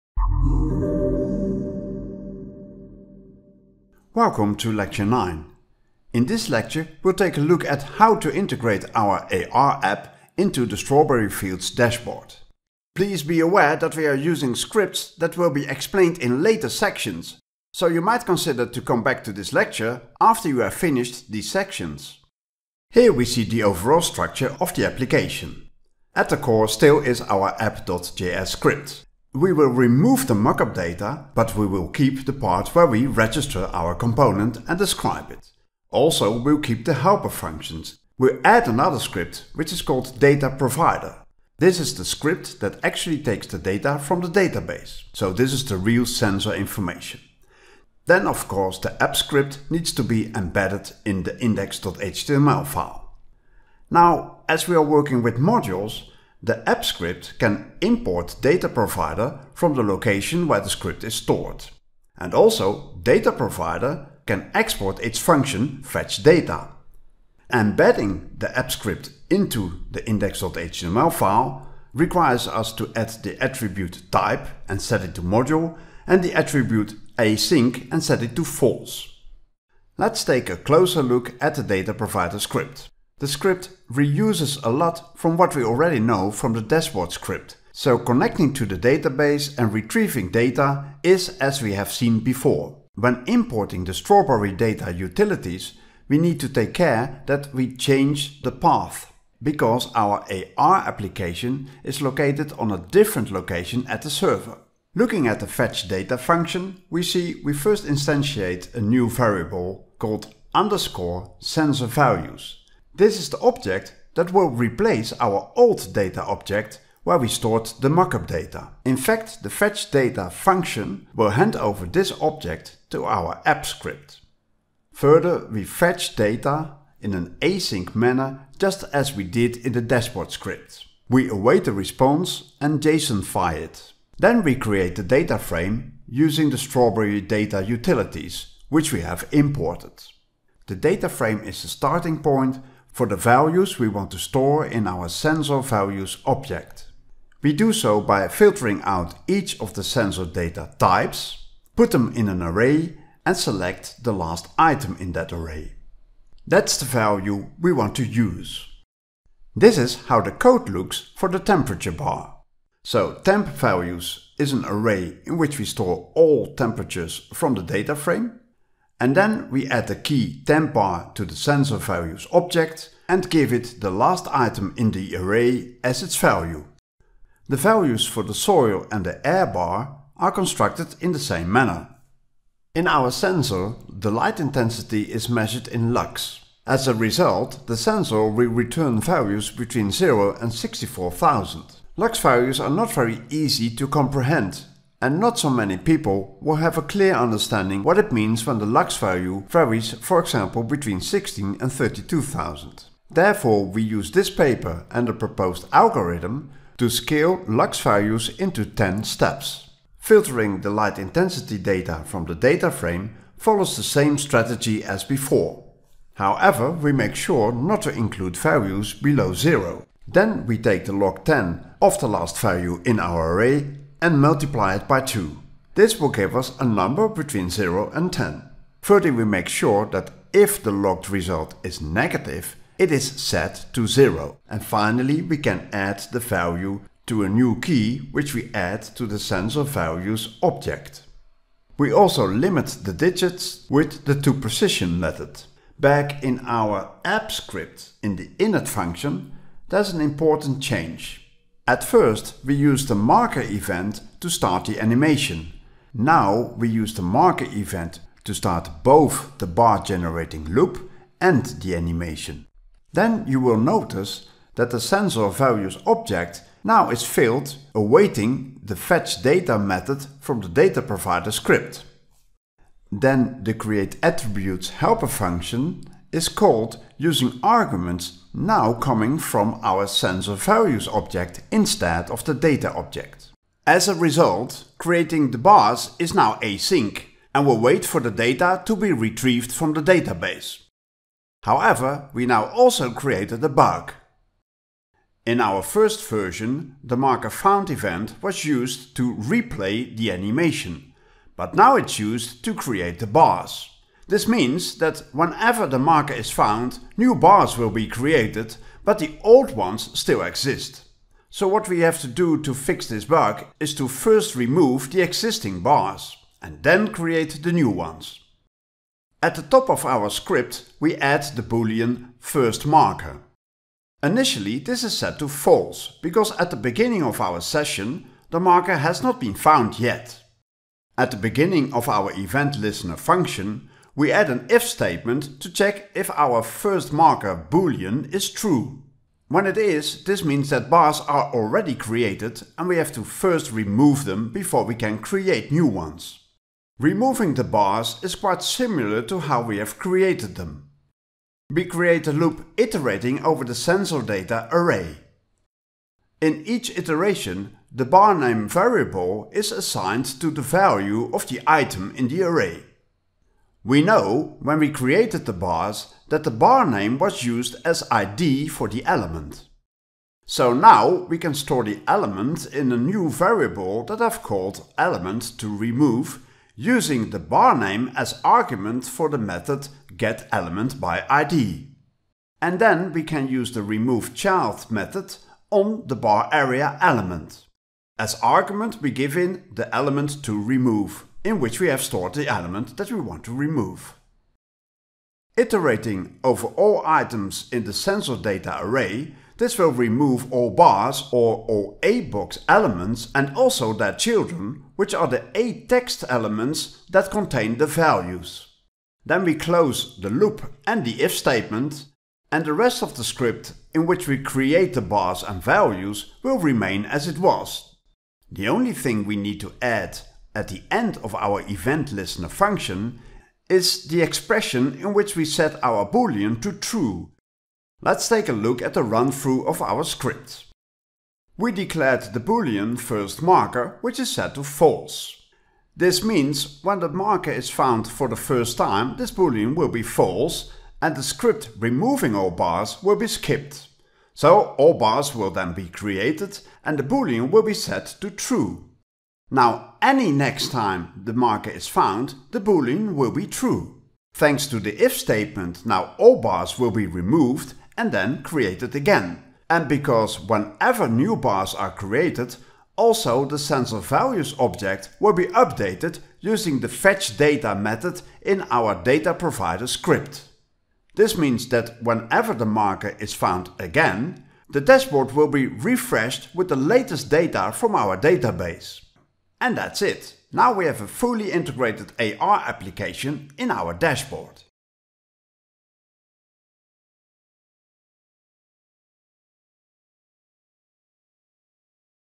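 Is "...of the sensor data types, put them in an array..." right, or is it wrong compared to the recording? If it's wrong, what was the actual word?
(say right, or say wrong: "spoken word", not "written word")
right.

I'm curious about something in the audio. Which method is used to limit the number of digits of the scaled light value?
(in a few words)
toPrecision.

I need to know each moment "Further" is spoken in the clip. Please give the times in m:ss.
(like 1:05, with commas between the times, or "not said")
2:04, 3:48.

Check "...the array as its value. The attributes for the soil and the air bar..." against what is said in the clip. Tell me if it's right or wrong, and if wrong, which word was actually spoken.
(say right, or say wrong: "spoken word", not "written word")
wrong: "values", not "attributes".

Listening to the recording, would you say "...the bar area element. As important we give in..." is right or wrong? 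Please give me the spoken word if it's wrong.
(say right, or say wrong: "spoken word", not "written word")
wrong: "argument", not "important".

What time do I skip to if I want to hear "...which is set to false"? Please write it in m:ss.
7:13.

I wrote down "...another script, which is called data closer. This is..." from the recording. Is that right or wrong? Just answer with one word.
wrong.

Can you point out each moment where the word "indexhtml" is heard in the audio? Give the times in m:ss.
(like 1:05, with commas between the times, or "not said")
0:51, 1:10.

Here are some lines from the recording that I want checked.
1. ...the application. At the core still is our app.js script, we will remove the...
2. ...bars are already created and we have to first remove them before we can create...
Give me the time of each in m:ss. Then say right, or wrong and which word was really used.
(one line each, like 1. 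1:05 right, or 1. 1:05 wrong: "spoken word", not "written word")
1. 0:24 right
2. 5:40 right.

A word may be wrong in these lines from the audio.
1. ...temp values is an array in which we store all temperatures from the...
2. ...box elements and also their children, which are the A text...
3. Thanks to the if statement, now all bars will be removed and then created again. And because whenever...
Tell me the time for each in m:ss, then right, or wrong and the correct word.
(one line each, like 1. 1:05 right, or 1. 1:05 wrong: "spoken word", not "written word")
1. 2:43 right
2. 6:42 right
3. 7:34 right.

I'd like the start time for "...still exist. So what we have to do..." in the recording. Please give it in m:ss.
5:09.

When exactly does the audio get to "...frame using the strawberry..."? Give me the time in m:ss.
2:15.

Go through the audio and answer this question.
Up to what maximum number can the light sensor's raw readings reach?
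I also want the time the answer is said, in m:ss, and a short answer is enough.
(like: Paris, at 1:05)
64,000, at 3:10.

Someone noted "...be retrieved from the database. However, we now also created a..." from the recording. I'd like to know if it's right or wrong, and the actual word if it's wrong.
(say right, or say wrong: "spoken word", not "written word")
right.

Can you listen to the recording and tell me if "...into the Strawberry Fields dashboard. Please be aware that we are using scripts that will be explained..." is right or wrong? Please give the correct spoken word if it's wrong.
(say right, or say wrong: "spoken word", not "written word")
right.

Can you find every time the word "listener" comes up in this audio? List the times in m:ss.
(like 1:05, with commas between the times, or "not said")
5:32, 7:01.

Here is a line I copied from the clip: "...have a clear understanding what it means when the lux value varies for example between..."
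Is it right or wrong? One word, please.
right.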